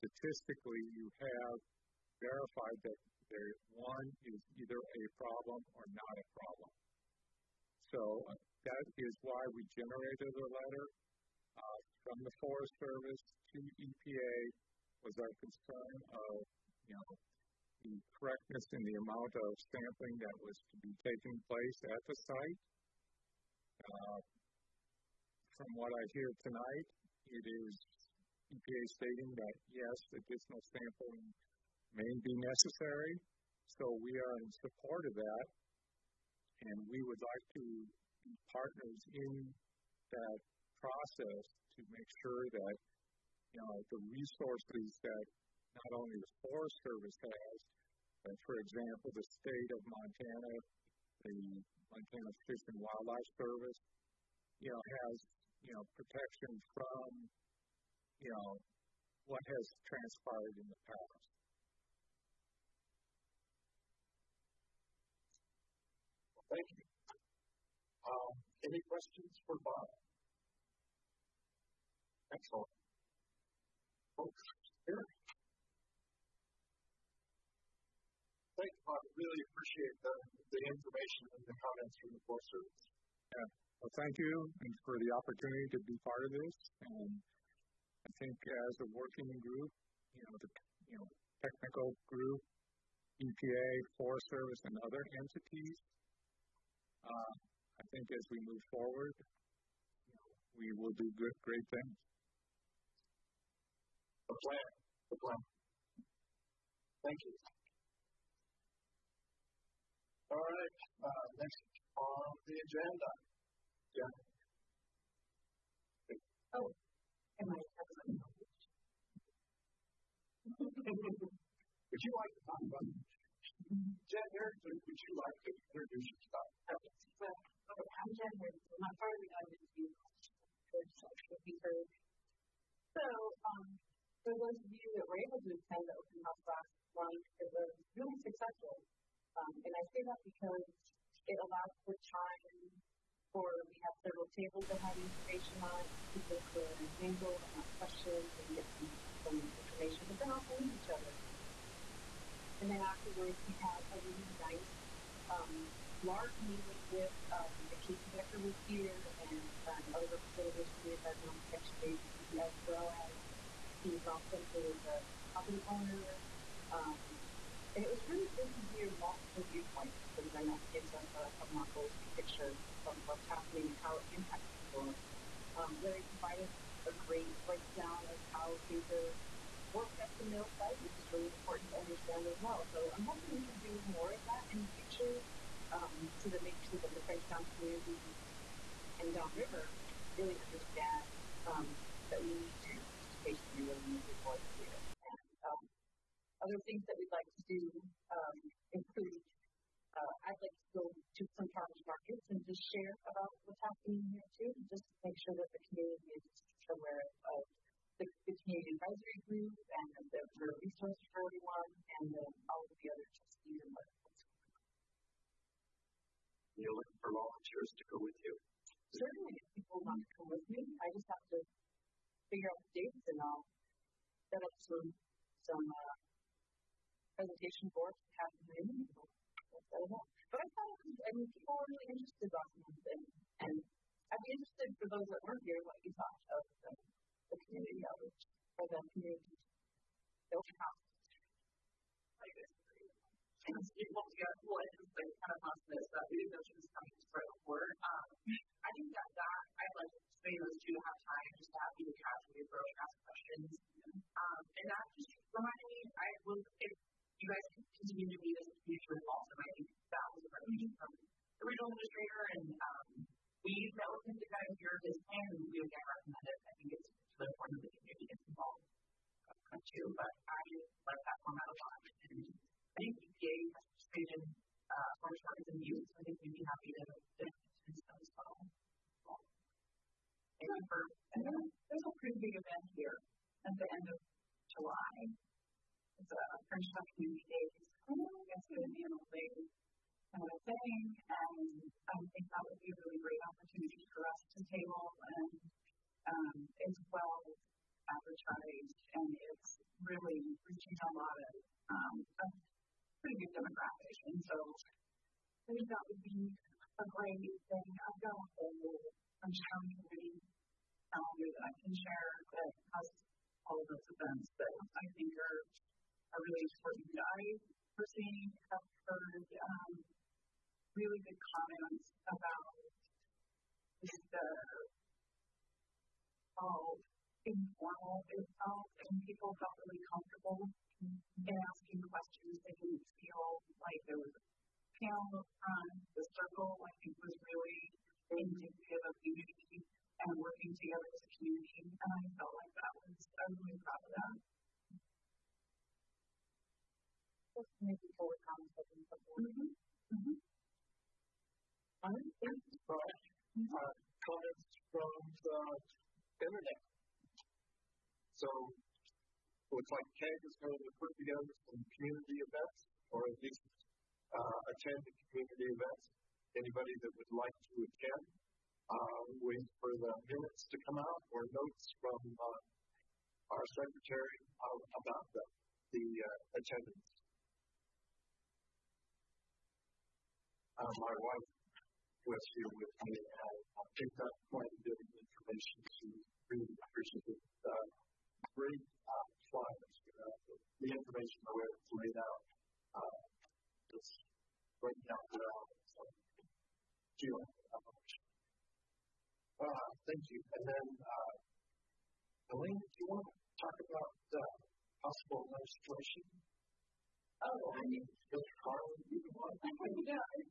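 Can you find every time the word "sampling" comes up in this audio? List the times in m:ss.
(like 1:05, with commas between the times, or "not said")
0:19, 0:30.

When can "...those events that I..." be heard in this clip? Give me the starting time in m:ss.
5:13.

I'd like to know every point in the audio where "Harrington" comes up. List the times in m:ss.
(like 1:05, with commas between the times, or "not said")
2:04, 2:08.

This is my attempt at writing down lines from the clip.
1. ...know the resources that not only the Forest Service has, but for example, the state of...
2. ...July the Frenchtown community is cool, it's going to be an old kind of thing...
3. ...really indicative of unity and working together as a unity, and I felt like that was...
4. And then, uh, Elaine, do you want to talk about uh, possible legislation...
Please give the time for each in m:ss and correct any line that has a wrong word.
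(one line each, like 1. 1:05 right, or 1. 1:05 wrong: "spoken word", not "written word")
1. 0:43 right
2. 4:44 right
3. 5:37 wrong: "community", not "unity"
4. 6:40 right.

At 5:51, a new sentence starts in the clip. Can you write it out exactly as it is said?
I'm inspired by uh, comments from the internet.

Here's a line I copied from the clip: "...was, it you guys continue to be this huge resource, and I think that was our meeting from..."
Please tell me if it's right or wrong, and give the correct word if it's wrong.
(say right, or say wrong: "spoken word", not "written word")
right.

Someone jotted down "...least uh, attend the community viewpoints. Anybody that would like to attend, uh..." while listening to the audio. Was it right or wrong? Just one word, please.
wrong.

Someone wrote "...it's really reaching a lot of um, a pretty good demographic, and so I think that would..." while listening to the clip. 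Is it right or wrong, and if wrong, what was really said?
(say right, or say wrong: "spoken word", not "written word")
right.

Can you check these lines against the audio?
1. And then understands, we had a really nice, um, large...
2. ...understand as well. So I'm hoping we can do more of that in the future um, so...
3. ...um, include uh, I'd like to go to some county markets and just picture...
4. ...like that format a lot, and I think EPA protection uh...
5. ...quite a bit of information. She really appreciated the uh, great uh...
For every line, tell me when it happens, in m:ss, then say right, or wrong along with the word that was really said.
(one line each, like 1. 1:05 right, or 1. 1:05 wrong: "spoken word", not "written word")
1. 2:32 wrong: "afterwards", not "understands"
2. 3:01 right
3. 3:18 wrong: "share", not "picture"
4. 4:30 wrong: "participation", not "protection"
5. 6:24 right.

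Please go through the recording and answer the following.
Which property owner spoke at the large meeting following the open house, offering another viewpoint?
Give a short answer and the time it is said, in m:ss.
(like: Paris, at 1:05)
Steve Rossum, at 2:43.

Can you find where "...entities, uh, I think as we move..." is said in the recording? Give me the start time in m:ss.
1:35.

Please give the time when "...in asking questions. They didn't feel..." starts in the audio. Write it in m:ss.
5:30.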